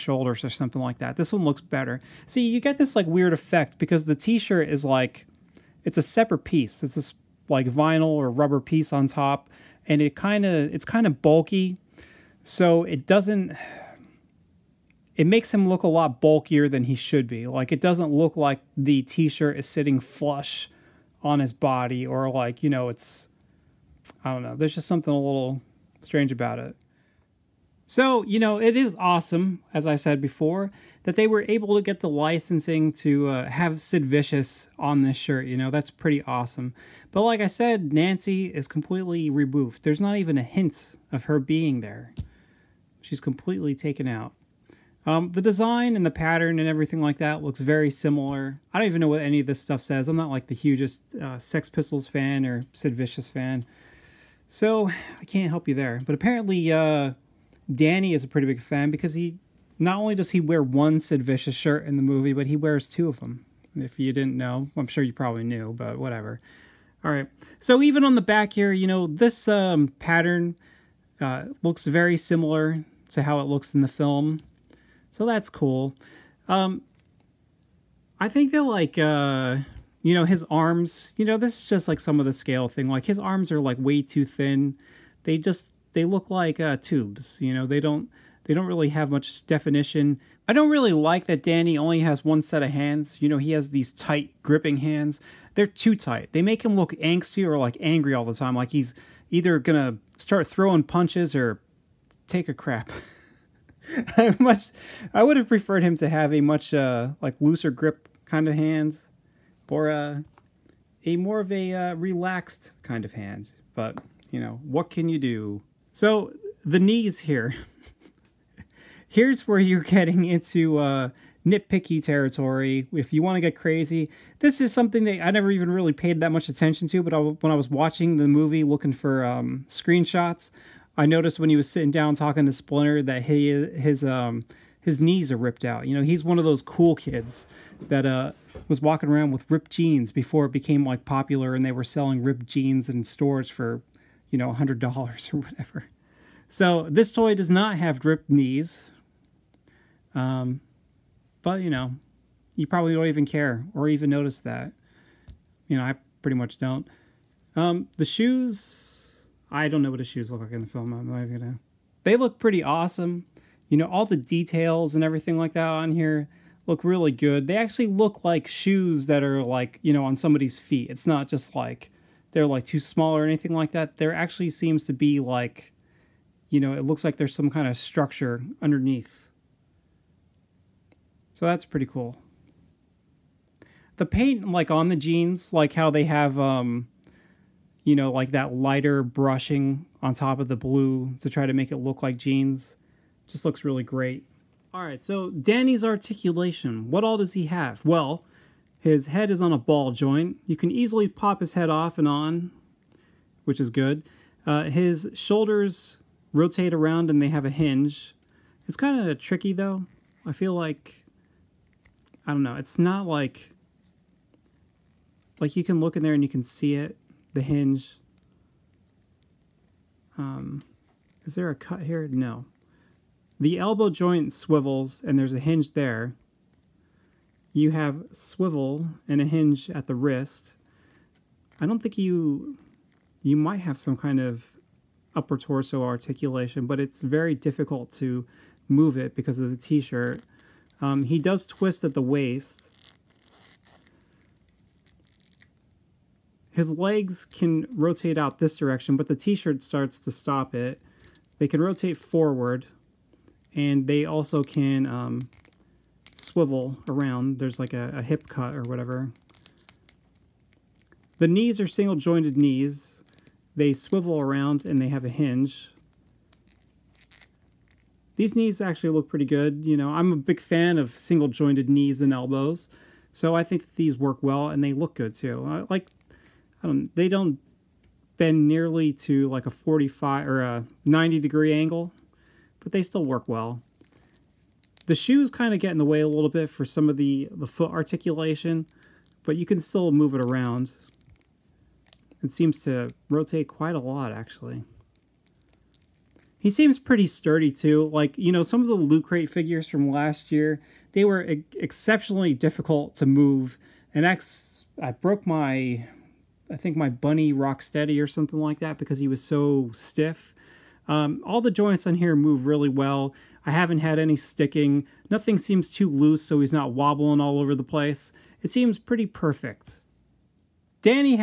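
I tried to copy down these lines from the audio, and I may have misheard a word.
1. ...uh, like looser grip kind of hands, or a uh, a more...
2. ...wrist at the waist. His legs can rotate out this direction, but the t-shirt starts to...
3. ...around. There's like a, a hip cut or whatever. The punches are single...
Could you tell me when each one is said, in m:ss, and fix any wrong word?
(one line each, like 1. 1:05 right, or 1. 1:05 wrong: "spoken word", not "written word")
1. 1:46 right
2. 4:01 wrong: "twist", not "wrist"
3. 4:16 wrong: "knees", not "punches".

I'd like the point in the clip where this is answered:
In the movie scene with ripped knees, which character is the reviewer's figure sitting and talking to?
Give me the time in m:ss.
2:12.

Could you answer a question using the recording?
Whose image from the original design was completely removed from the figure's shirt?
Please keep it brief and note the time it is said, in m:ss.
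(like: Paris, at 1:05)
Nancy, at 0:37.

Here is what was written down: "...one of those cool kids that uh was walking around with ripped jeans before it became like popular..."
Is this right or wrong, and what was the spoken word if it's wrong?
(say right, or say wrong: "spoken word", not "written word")
right.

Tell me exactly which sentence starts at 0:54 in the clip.
So I can't help you there.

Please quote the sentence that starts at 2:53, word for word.
There actually seems to be like, you know, it looks like there's some kind of structure underneath.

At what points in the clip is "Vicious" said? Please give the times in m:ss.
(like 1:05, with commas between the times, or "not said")
0:34, 0:52, 1:01.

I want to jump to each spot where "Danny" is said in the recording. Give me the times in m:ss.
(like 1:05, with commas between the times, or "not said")
0:57, 1:31, 3:15.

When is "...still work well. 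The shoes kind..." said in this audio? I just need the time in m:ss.
4:42.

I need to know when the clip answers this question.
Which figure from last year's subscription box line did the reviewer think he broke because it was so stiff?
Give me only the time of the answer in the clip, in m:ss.
5:07.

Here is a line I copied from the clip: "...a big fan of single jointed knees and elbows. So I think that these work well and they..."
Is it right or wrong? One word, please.
right.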